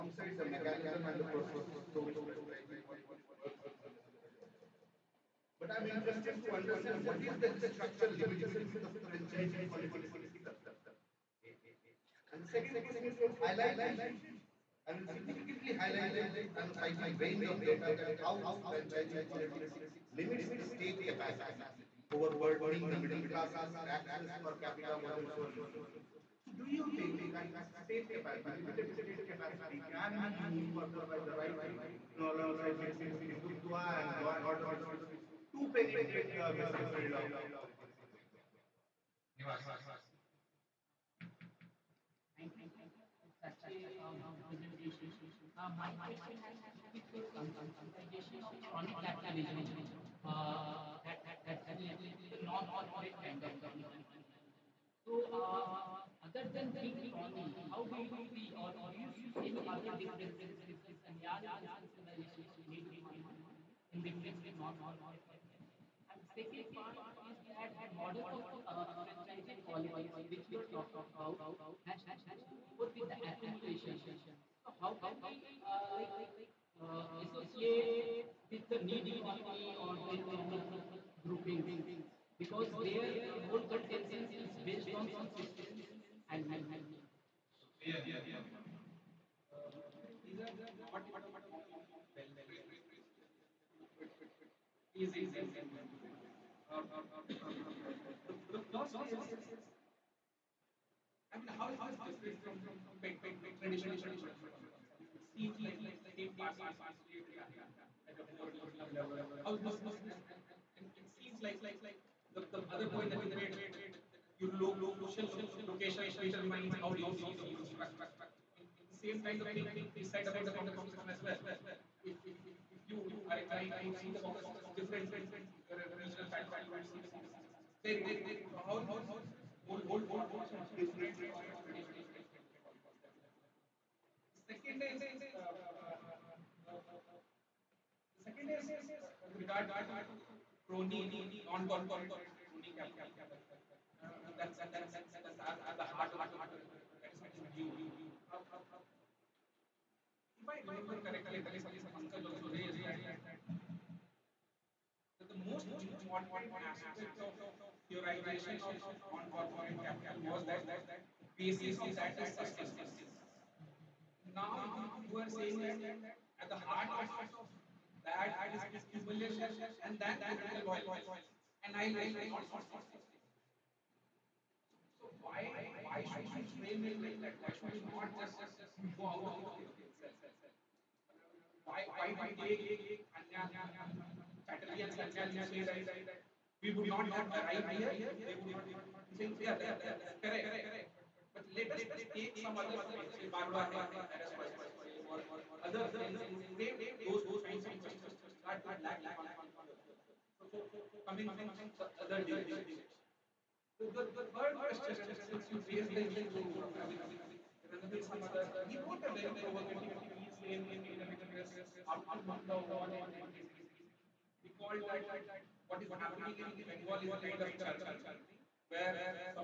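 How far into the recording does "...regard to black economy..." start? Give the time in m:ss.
3:18.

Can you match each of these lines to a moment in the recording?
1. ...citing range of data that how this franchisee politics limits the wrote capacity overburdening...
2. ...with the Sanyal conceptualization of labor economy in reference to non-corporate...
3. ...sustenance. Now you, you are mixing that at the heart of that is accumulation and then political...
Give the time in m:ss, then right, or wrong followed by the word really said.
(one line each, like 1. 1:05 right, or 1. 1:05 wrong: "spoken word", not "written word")
1. 0:16 wrong: "state", not "wrote"
2. 1:00 right
3. 2:42 wrong: "saying", not "mixing".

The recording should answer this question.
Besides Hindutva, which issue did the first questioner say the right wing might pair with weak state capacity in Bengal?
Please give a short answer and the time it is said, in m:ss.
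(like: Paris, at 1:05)
Law and order, at 0:34.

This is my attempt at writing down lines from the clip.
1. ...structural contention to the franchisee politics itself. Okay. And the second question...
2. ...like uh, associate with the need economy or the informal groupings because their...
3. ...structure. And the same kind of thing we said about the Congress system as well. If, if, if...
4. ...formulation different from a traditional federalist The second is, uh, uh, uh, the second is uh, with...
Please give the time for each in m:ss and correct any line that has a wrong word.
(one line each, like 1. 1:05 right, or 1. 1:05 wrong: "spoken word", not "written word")
1. 0:07 wrong: "limitation", not "contention"
2. 1:15 right
3. 1:57 right
4. 2:10 right.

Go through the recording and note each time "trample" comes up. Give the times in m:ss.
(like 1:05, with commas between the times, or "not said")
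not said.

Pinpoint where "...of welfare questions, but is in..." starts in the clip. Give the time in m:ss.
1:31.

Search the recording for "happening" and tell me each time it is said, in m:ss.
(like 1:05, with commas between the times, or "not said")
1:47, 3:35.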